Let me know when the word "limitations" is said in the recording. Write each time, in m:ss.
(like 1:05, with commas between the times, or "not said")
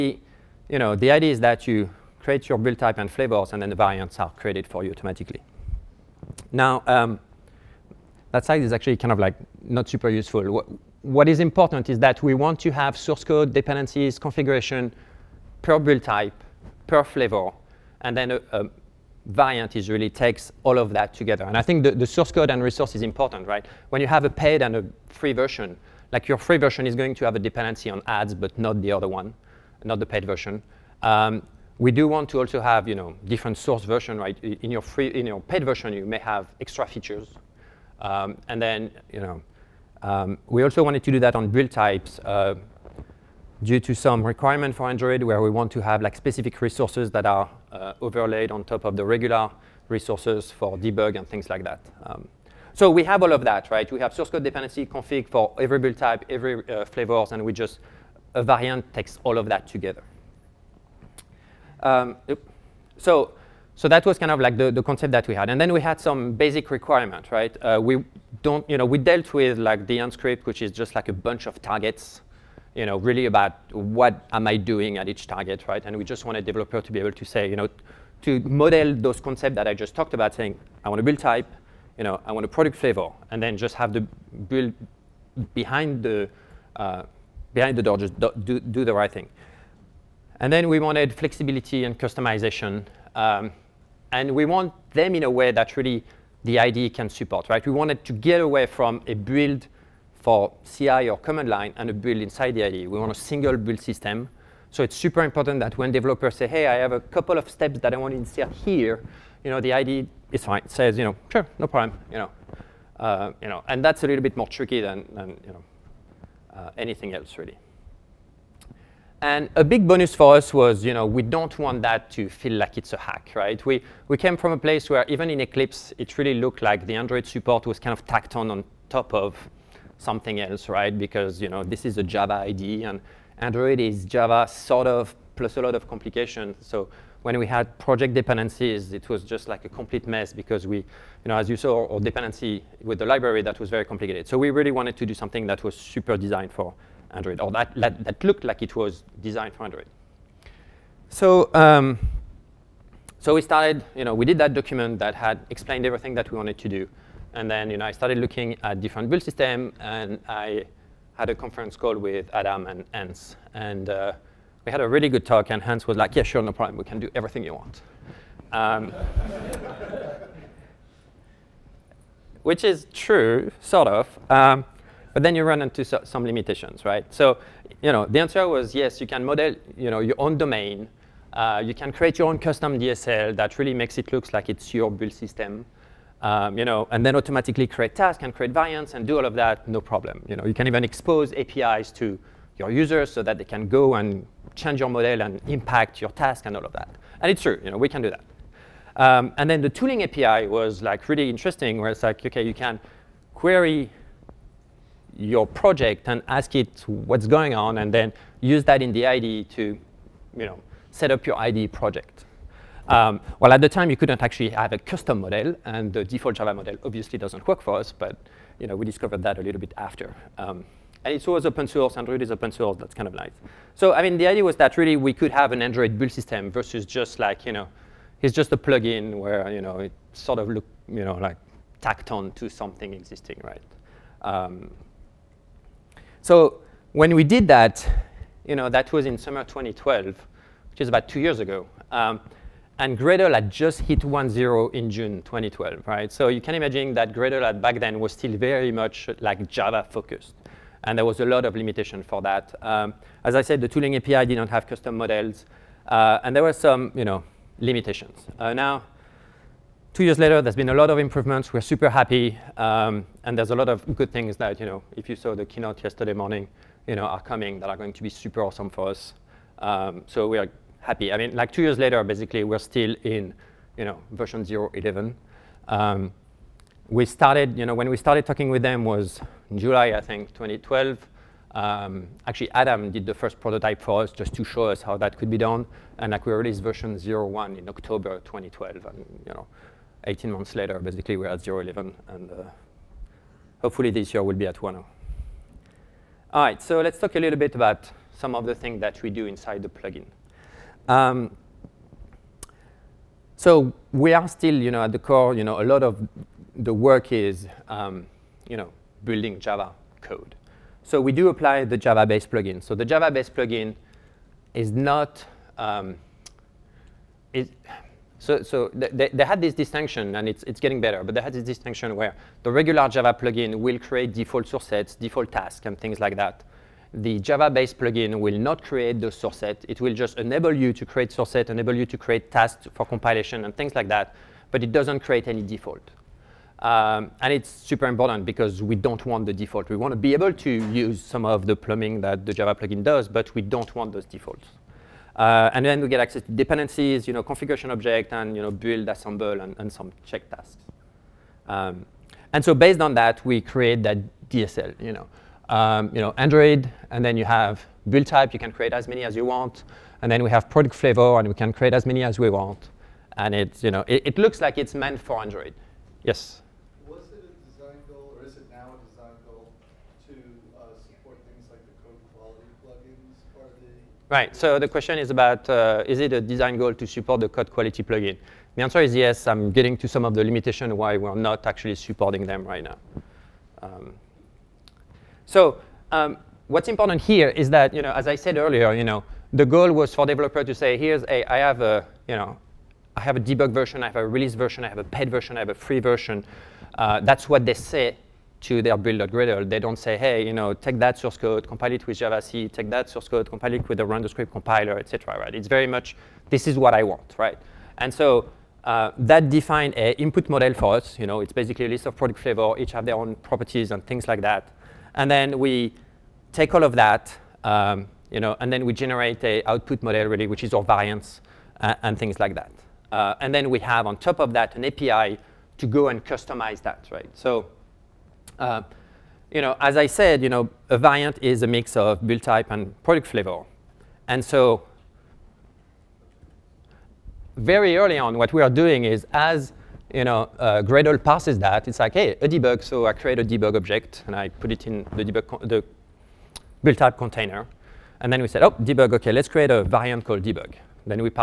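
2:56, 4:11, 4:17, 6:20.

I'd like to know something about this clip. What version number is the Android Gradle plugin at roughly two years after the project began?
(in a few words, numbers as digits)
0.11.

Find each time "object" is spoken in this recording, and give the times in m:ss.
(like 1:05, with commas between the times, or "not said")
5:47, 7:23.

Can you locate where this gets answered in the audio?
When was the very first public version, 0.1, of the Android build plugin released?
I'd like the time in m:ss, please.
4:47.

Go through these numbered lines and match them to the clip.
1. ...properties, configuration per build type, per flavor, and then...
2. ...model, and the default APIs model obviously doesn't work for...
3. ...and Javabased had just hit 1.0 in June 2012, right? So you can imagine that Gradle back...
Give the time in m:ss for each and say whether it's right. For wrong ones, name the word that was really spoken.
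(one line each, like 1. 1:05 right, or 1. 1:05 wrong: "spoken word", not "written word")
1. 0:13 wrong: "dependencies", not "properties"
2. 3:35 wrong: "Java", not "APIs"
3. 4:02 wrong: "Gradle", not "Javabased".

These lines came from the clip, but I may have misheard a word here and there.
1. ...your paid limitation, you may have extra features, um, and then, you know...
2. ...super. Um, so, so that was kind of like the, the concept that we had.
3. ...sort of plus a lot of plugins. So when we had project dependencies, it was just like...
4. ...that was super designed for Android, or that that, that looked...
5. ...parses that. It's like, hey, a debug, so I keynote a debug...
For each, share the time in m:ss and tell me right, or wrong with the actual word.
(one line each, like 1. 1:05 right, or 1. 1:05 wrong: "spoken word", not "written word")
1. 0:35 wrong: "version", not "limitation"
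2. 0:59 wrong: "together", not "super"
3. 2:14 wrong: "complications", not "plugins"
4. 2:25 right
5. 7:21 wrong: "create", not "keynote".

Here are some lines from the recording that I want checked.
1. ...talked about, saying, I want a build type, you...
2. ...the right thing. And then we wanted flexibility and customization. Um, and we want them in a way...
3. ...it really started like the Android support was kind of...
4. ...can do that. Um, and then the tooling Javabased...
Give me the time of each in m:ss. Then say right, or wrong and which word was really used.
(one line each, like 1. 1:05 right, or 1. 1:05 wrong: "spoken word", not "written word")
1. 1:19 right
2. 1:28 right
3. 2:05 wrong: "looked", not "started"
4. 3:17 wrong: "API", not "Javabased".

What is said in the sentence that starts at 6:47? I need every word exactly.
And so uh, that defined a input model for us.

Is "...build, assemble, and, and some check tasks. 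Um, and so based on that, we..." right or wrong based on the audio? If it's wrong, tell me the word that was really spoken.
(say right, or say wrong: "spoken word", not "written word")
right.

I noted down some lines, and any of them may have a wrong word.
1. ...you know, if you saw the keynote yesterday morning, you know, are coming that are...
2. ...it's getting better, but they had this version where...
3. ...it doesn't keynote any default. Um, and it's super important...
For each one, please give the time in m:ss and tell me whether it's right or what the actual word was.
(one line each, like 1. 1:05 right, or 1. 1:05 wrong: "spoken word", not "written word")
1. 4:24 right
2. 5:20 wrong: "distinction", not "version"
3. 5:34 wrong: "create", not "keynote".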